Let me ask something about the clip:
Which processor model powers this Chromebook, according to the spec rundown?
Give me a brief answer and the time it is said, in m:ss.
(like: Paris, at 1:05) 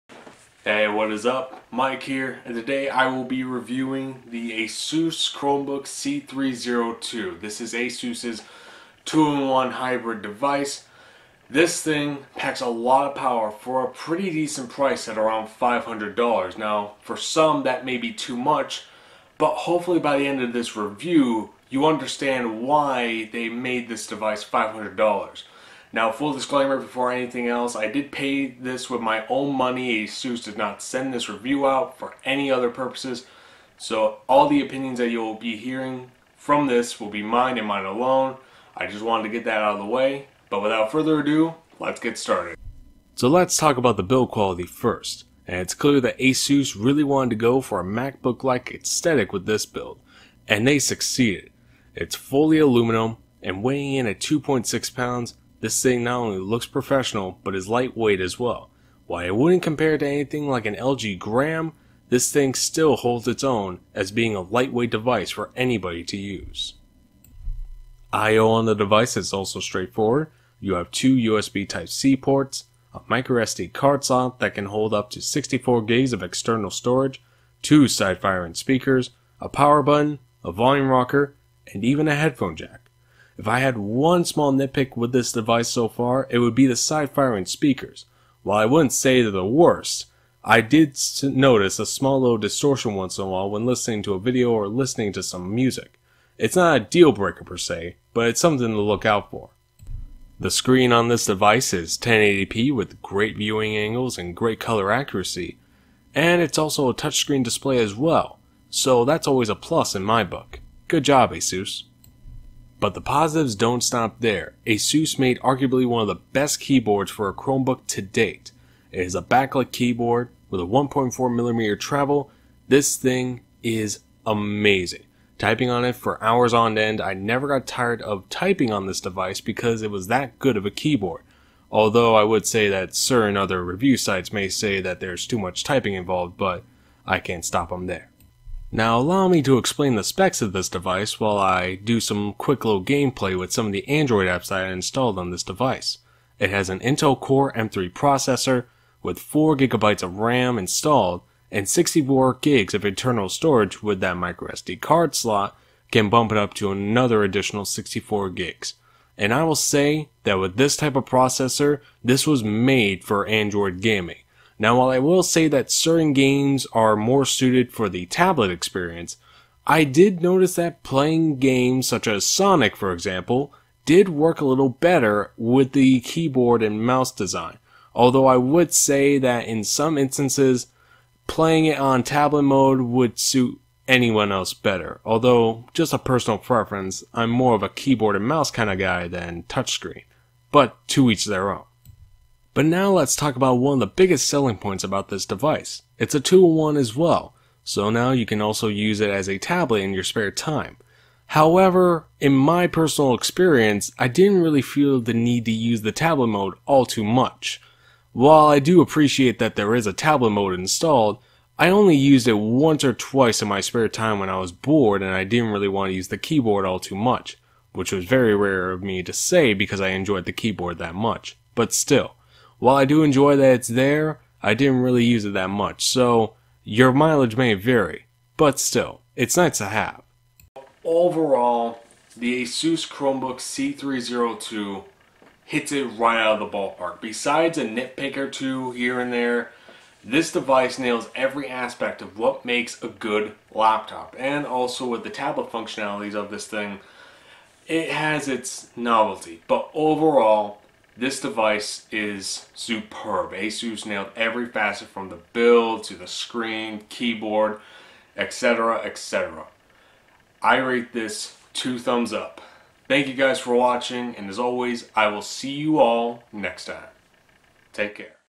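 Intel Core M3, at 2:26.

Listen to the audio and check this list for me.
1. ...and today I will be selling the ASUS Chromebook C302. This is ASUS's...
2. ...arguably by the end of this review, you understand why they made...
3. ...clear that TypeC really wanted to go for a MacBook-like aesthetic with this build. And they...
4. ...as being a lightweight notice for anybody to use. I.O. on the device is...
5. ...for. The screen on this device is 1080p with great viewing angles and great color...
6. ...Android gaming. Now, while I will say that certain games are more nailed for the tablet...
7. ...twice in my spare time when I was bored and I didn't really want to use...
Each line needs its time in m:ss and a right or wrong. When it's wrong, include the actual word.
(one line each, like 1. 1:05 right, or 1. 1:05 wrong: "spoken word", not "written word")
1. 0:02 wrong: "reviewing", not "selling"
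2. 0:19 wrong: "hopefully", not "arguably"
3. 0:45 wrong: "ASUS", not "TypeC"
4. 1:03 wrong: "device", not "notice"
5. 1:39 right
6. 2:43 wrong: "suited", not "nailed"
7. 3:32 right.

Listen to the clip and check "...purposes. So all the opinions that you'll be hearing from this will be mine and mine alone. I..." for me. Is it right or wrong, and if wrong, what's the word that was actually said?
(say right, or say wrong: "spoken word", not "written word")
right.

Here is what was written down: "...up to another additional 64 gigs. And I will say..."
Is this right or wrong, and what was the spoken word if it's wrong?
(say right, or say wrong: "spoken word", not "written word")
right.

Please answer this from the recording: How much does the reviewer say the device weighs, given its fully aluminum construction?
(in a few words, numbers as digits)
2.6 pounds.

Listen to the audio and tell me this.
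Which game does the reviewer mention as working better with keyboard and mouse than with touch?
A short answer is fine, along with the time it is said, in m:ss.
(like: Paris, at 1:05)
Sonic, at 2:52.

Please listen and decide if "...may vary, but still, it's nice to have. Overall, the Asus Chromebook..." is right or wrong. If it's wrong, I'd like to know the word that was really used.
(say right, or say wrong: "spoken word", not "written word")
right.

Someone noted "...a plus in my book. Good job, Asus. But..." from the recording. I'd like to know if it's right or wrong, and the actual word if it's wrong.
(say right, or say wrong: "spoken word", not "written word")
right.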